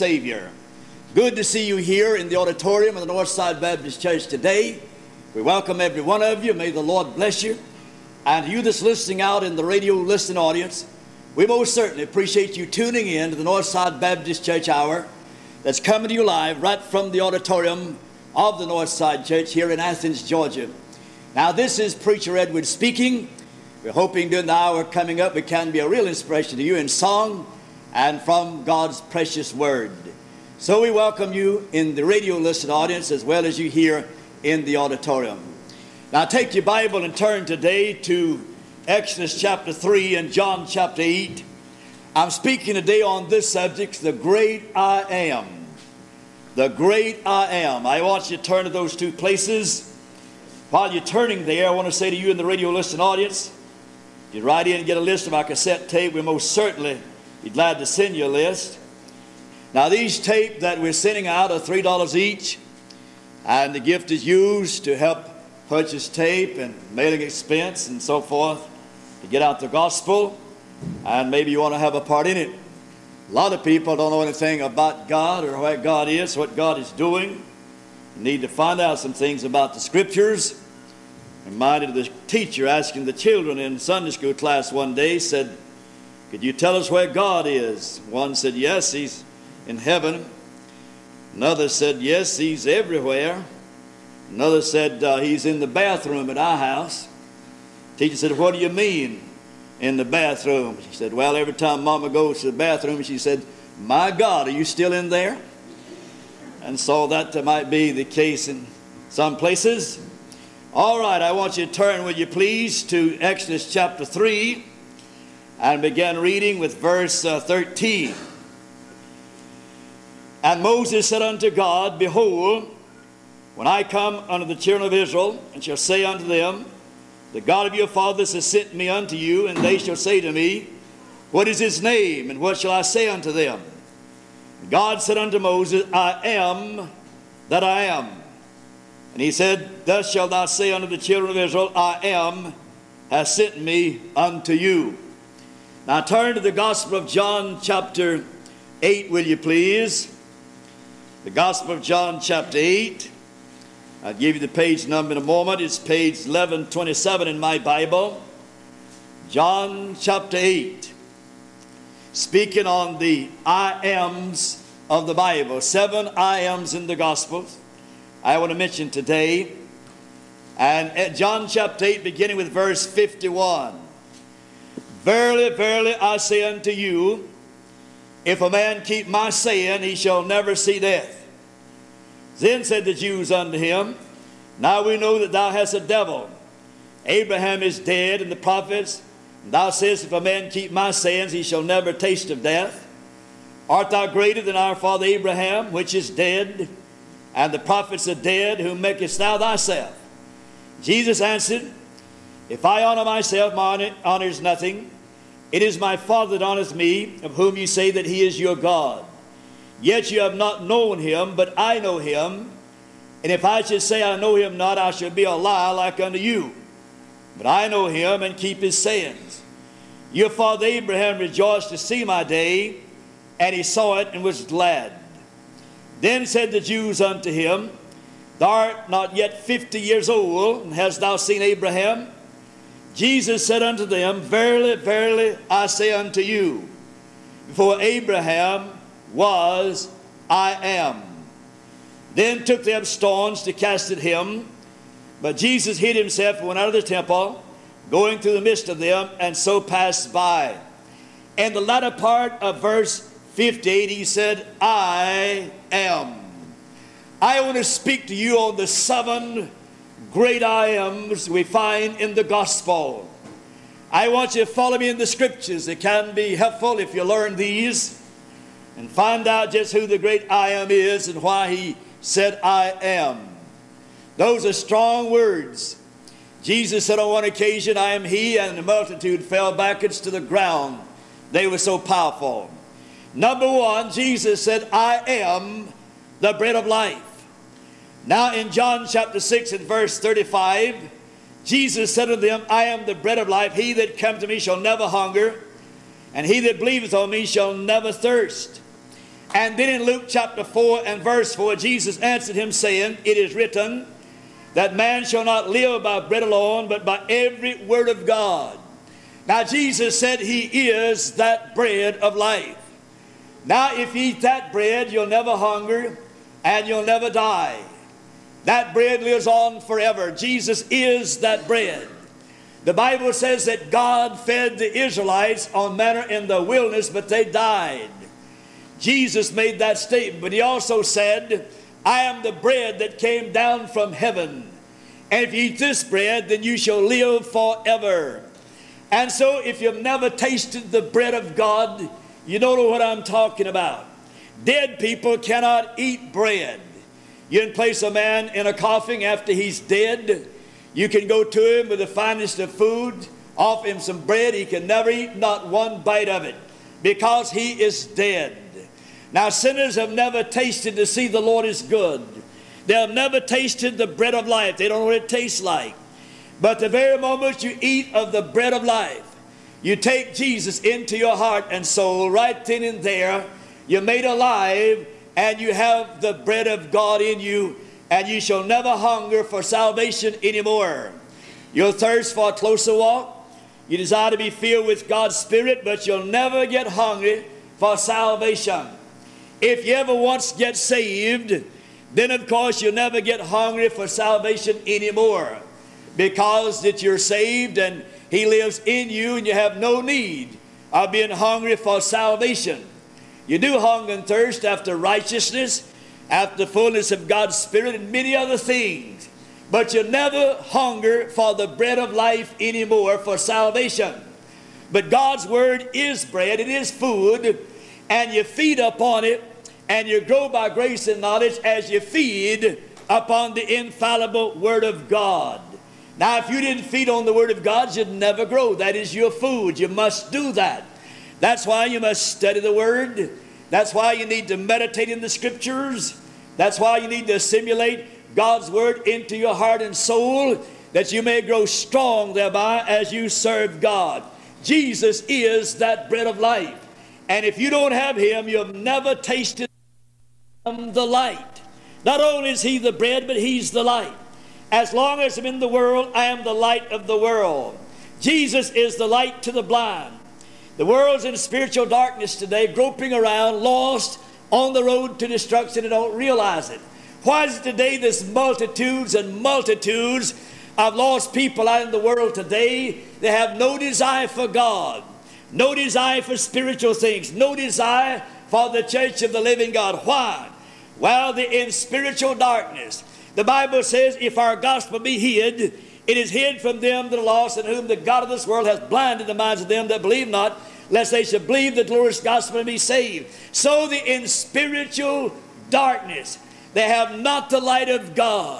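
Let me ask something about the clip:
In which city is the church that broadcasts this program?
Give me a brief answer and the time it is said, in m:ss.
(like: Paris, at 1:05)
Athens, Georgia, at 0:19.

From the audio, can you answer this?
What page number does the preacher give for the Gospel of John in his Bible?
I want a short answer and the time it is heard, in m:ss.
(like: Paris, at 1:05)
1127, at 2:36.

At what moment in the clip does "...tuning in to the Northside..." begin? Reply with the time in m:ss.
0:12.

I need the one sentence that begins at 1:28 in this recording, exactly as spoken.
One said, Yes, he's in heaven.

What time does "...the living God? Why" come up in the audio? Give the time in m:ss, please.
7:59.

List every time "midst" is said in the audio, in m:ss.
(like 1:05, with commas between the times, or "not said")
4:08.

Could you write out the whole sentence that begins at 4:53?
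He that comes to me shall never hunger, and he that believeth on me shall never thirst.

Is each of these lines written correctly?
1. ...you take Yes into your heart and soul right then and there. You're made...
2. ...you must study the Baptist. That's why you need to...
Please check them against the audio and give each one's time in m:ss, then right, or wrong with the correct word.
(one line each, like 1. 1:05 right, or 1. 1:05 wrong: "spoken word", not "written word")
1. 6:09 wrong: "Jesus", not "Yes"
2. 7:11 wrong: "Word", not "Baptist".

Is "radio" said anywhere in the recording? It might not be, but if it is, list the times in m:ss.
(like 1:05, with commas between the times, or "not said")
0:09, 0:32, 0:52.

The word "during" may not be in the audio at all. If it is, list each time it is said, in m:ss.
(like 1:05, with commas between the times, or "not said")
0:24.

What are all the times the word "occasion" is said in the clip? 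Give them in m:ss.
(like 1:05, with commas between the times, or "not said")
4:37.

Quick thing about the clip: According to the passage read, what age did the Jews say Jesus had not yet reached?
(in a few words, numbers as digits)
50.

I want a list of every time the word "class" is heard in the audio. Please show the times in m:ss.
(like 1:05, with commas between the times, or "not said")
1:24.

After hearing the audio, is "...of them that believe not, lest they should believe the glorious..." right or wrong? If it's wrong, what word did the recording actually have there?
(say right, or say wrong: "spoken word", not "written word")
right.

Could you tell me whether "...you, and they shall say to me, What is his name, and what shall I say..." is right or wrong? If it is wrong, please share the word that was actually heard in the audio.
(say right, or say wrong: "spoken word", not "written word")
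right.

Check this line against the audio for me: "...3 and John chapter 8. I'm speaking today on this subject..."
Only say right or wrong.
right.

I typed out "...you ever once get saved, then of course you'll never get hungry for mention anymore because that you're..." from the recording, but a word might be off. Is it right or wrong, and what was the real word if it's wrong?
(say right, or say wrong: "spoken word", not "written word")
wrong: "salvation", not "mention".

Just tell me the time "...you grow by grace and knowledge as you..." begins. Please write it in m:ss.
6:59.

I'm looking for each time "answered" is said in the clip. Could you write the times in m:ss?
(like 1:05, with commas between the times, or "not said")
3:21, 5:01.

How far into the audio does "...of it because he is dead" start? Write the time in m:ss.
5:56.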